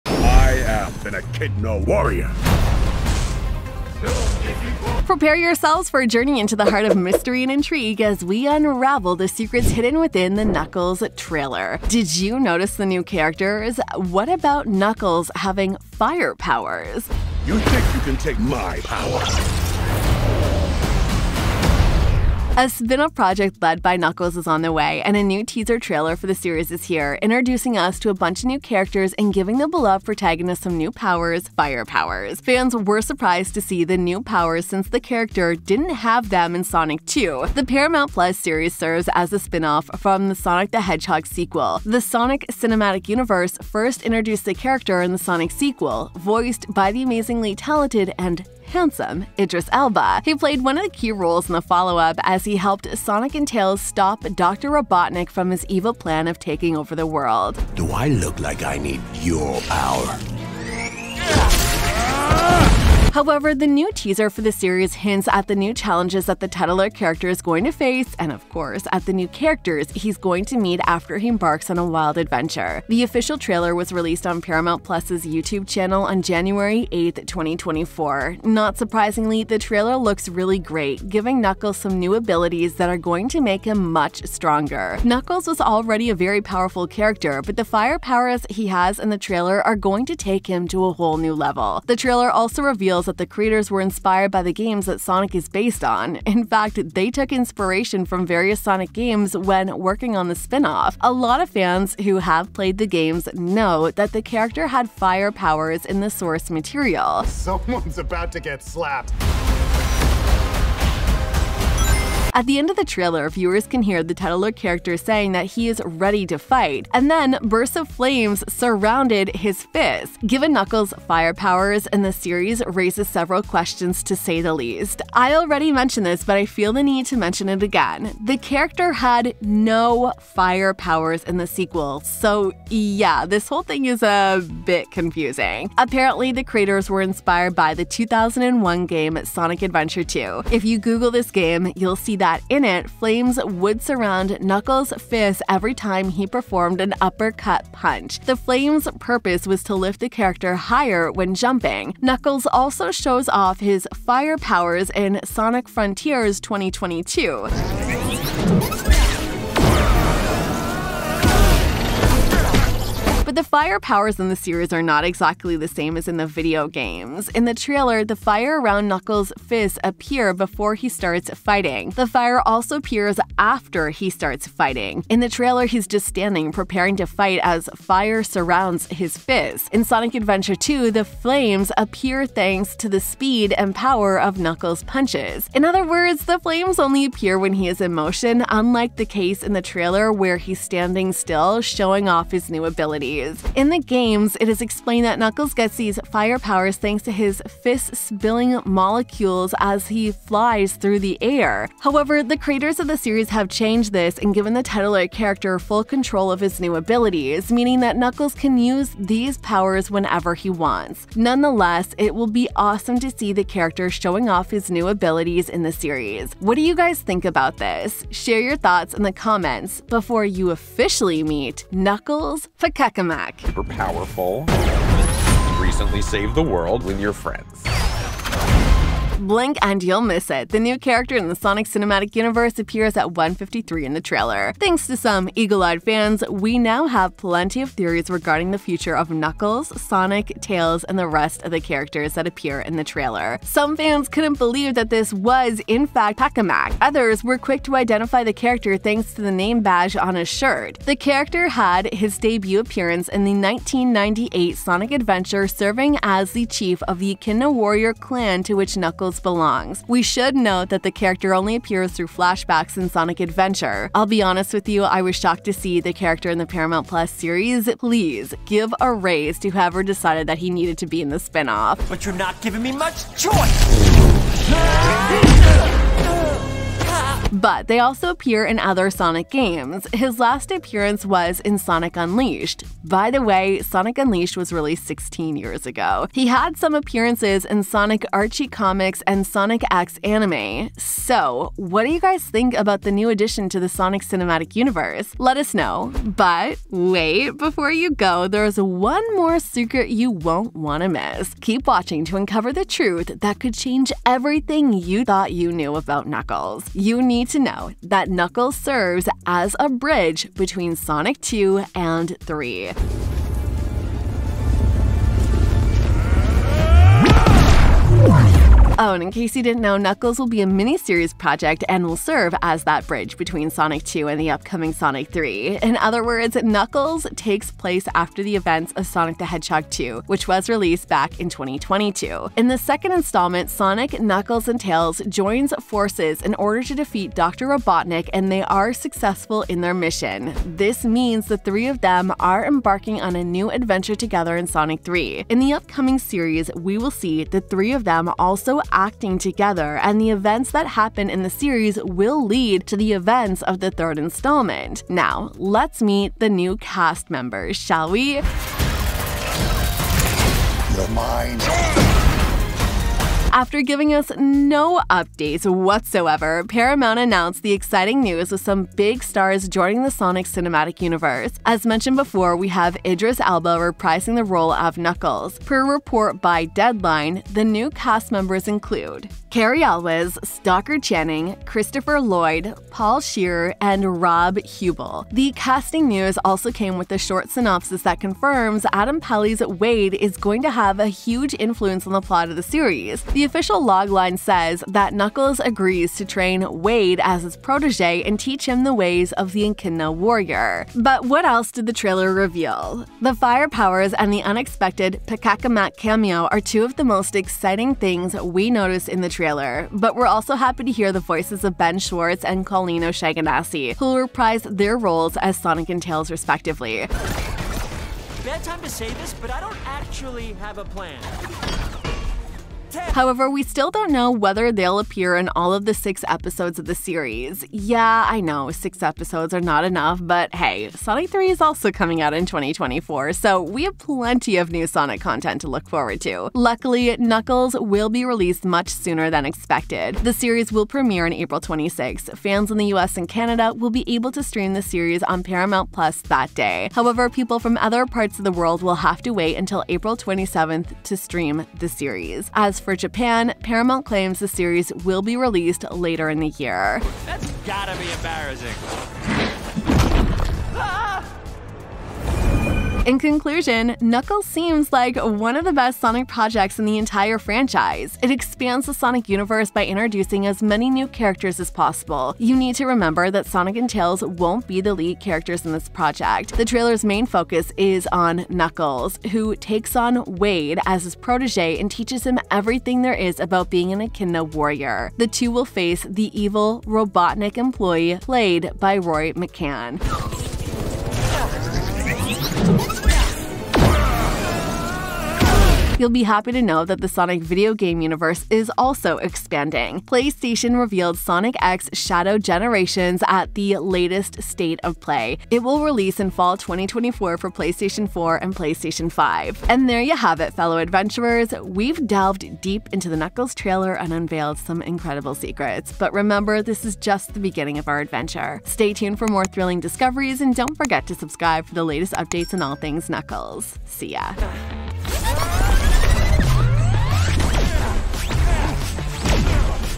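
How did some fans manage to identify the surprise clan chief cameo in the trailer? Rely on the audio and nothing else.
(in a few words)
Name badge.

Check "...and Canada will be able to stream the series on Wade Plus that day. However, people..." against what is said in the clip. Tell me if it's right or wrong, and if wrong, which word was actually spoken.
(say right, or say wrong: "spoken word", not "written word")
wrong: "Paramount", not "Wade".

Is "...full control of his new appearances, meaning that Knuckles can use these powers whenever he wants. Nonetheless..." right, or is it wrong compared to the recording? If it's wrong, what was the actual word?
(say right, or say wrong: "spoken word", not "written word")
wrong: "abilities", not "appearances".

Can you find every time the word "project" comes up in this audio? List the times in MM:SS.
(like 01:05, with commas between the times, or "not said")
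00:23, 05:21, 07:46, 07:55.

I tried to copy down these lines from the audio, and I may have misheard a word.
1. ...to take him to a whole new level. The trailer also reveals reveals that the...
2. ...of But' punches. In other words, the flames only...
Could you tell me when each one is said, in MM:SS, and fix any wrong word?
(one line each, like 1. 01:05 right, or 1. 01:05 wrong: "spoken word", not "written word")
1. 01:30 right
2. 03:04 wrong: "Knuckles", not "But".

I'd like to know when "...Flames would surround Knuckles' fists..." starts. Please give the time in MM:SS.
02:22.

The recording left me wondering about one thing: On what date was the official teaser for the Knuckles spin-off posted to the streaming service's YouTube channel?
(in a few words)
January 8, 2024.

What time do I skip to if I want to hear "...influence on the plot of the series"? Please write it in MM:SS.
06:31.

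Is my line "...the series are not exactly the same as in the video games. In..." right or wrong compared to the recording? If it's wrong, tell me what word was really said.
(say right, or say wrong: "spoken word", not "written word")
right.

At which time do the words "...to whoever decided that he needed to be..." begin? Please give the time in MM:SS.
04:29.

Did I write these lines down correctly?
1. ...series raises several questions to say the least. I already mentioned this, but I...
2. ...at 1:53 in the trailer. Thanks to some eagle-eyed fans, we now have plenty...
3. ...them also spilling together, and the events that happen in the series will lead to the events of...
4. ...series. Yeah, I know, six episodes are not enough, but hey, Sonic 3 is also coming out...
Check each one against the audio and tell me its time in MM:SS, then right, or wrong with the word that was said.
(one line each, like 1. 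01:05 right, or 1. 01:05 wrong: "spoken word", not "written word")
1. 02:02 right
2. 03:52 right
3. 05:47 wrong: "acting", not "spilling"
4. 07:06 right.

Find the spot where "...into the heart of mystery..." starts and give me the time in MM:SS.
00:06.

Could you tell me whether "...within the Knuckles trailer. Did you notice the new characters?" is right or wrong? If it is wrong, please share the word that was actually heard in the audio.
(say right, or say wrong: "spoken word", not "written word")
right.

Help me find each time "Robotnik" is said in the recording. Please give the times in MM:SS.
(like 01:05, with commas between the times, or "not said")
00:54, 05:37, 08:06.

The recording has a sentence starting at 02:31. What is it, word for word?
Knuckles also shows off his fire powers in Sonic Frontiers 2022.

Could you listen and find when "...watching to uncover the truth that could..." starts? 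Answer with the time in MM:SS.
05:01.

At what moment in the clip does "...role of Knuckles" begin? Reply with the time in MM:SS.
06:14.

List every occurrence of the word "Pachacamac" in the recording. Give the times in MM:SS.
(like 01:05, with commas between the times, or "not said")
04:06, 06:45.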